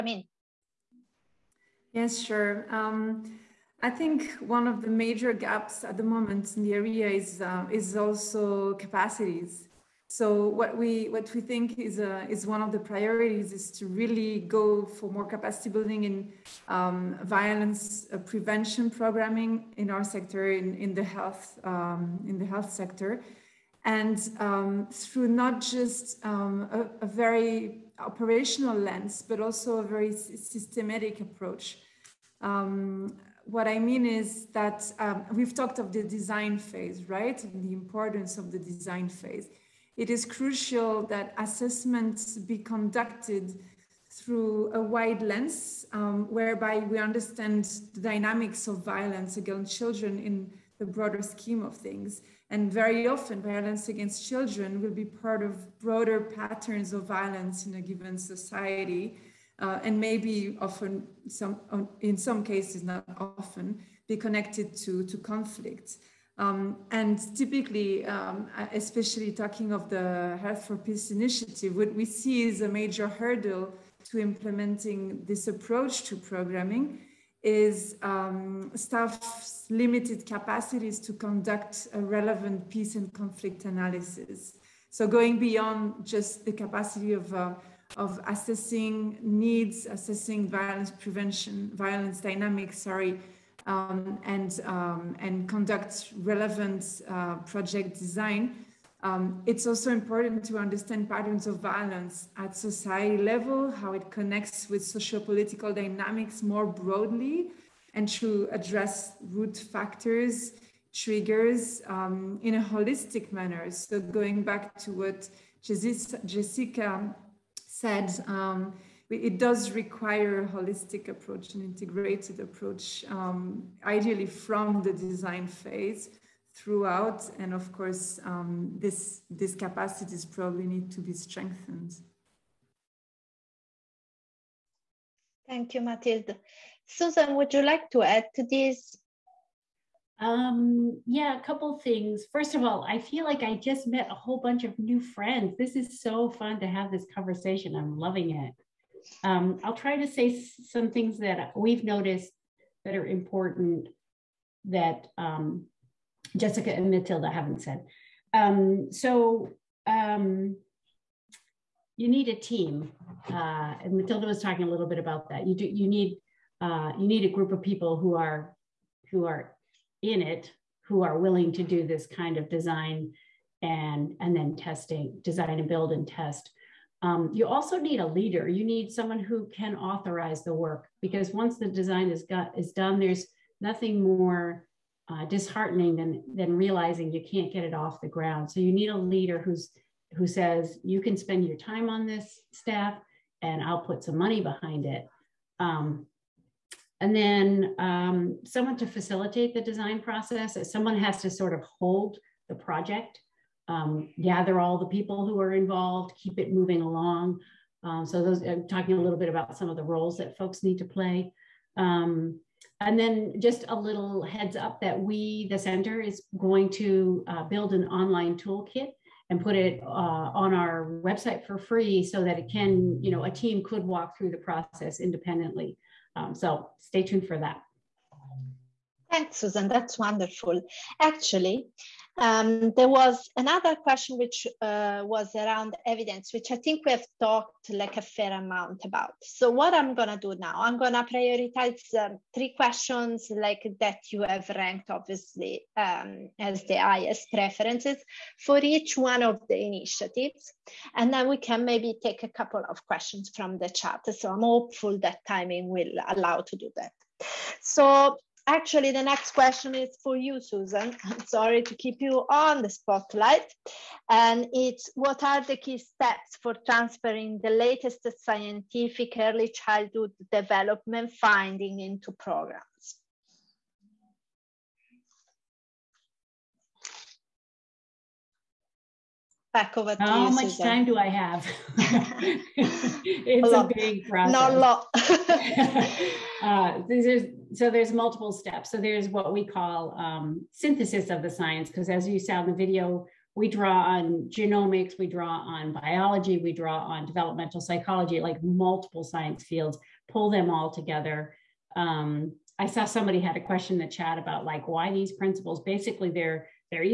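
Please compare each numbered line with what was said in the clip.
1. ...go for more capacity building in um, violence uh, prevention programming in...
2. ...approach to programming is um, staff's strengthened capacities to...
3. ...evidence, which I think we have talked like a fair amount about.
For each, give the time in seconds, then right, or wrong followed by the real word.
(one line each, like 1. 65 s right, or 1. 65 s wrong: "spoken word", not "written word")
1. 14 s right
2. 75 s wrong: "limited", not "strengthened"
3. 235 s right.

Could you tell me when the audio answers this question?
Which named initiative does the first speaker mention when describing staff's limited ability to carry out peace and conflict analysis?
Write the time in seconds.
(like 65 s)
70 s.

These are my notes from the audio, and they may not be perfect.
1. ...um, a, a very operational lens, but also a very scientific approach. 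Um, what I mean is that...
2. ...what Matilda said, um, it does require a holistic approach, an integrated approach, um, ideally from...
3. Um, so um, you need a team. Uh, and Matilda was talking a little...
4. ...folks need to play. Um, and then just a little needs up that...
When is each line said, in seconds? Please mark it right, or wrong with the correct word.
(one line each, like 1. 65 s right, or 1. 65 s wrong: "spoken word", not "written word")
1. 26 s wrong: "systematic", not "scientific"
2. 114 s wrong: "Jessica", not "Matilda"
3. 158 s right
4. 210 s wrong: "heads", not "needs".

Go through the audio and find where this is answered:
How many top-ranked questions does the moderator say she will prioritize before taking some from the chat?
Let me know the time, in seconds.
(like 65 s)
242 s.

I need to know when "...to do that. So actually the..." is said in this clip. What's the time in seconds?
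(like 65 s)
256 s.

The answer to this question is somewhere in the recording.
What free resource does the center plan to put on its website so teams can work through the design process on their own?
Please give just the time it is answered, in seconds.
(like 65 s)
217 s.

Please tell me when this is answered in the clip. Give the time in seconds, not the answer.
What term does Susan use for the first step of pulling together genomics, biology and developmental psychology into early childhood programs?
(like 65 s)
290 s.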